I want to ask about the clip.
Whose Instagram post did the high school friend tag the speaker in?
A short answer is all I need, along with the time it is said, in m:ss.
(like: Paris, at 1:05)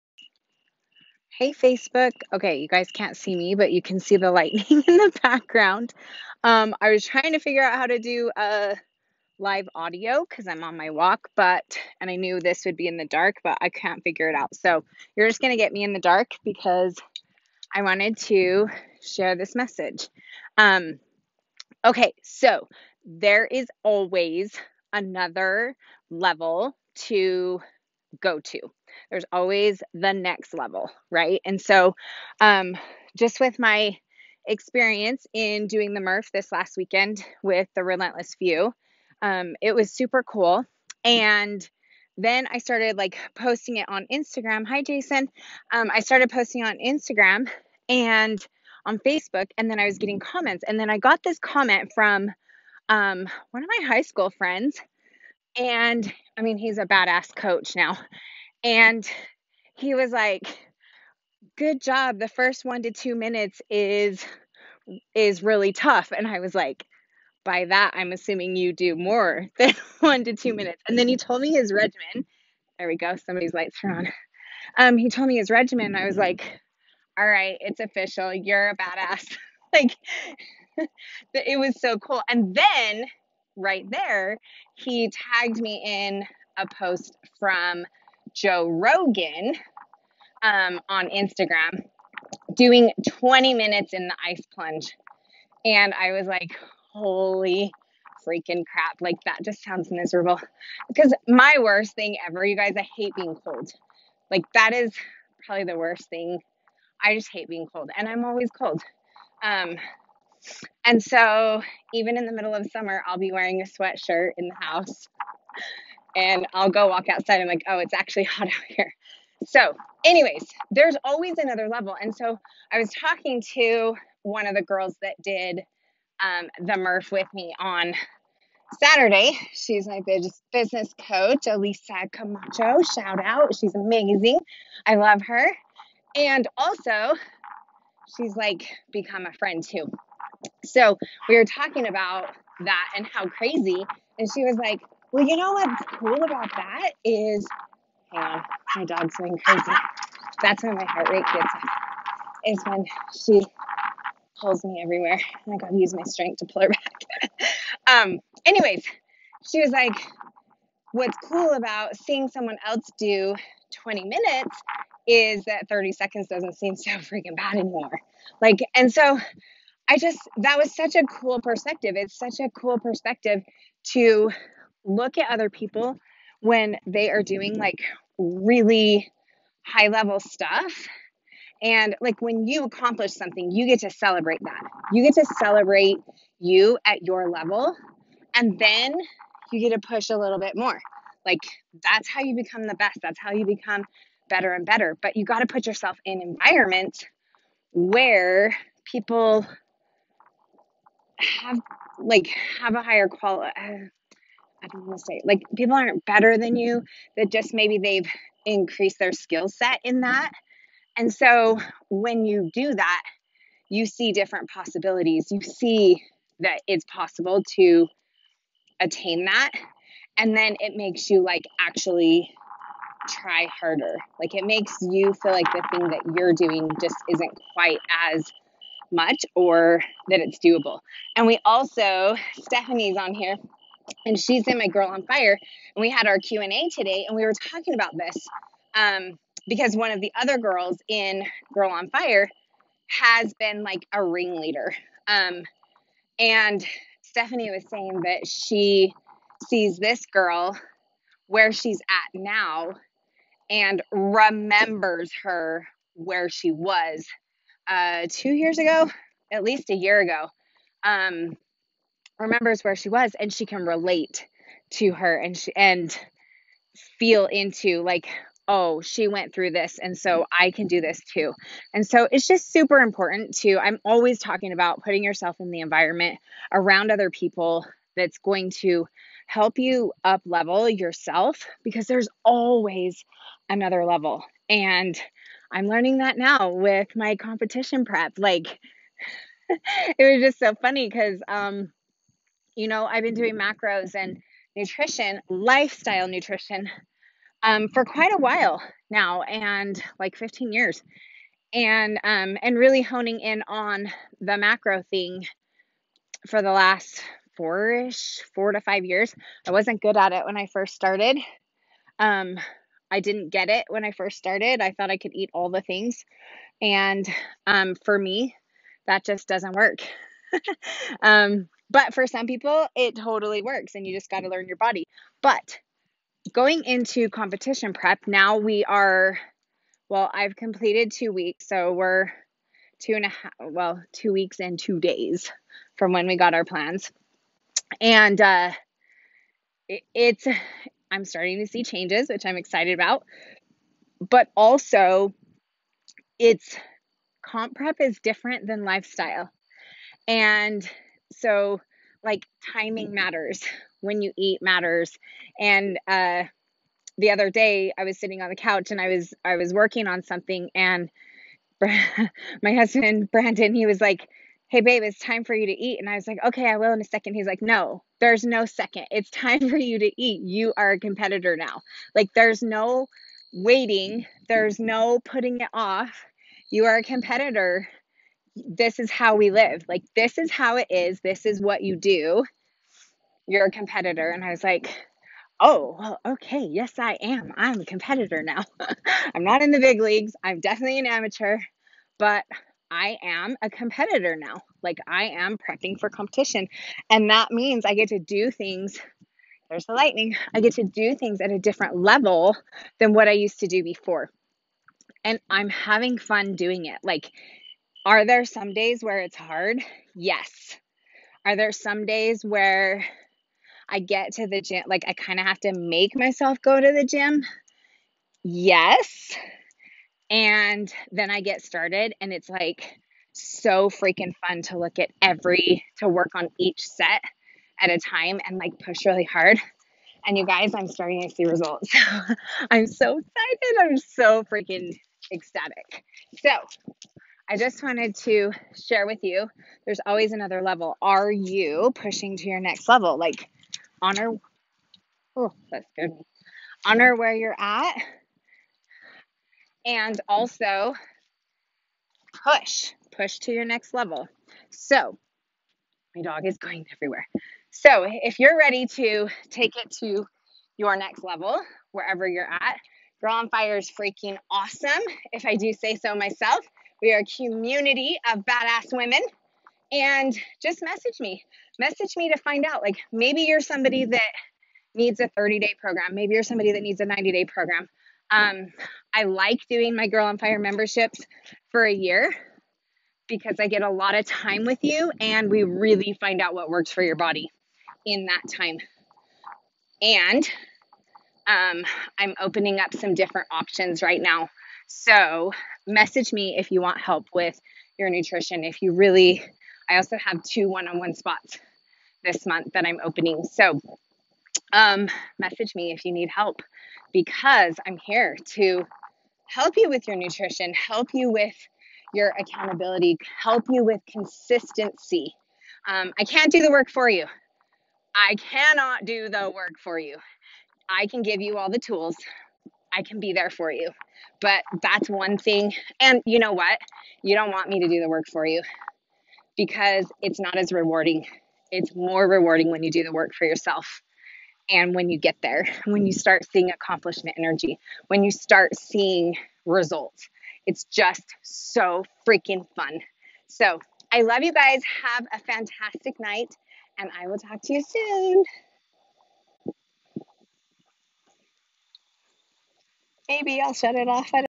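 Joe Rogan, at 1:28.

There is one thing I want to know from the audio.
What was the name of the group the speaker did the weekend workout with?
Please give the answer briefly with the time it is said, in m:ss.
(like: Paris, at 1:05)
Relentless Few, at 0:37.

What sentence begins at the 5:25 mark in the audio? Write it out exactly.
But going into competition prep, now we are, well, I've completed two weeks.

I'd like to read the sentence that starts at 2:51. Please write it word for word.
It's such a cool perspective to look at other people when they are doing like really high level stuff.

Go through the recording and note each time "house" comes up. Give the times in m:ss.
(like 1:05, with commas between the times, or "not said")
1:54.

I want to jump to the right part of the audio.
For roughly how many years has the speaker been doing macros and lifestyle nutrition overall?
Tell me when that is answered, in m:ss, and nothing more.
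5:00.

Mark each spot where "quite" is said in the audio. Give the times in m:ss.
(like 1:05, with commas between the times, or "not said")
3:47, 4:57.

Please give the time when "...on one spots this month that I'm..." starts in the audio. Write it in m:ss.
8:20.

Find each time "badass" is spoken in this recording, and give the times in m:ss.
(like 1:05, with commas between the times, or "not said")
0:56, 1:18, 7:48.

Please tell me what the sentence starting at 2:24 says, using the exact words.
And she was like, well, you know what's cool about that is, hang uh, on, my dog's going crazy.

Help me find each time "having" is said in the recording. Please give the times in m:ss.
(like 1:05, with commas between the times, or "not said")
6:45.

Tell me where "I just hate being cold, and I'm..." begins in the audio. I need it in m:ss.
1:47.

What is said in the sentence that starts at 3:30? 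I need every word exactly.
And so when you do that, you see different possibilities.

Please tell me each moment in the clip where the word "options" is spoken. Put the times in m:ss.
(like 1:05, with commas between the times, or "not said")
8:13.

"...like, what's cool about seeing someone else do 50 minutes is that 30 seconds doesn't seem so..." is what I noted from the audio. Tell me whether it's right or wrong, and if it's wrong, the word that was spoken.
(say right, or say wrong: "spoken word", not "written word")
wrong: "20", not "50".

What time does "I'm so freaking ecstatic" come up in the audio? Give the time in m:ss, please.
7:13.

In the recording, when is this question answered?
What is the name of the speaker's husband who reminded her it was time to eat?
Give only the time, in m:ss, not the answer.
6:03.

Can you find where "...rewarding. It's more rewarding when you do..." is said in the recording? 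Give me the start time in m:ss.
8:50.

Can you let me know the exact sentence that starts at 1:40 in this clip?
Because my worst thing ever, you guys, I hate being cold.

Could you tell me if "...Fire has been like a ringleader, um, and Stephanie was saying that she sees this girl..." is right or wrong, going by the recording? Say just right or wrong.
right.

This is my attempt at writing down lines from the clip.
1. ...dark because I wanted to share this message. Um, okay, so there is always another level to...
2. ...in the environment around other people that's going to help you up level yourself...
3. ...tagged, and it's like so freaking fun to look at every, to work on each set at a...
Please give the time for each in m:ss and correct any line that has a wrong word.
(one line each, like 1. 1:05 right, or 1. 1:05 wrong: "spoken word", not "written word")
1. 0:16 right
2. 4:35 right
3. 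7:01 wrong: "started", not "tagged".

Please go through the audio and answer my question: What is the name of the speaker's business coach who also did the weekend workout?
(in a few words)
Elisa Camacho.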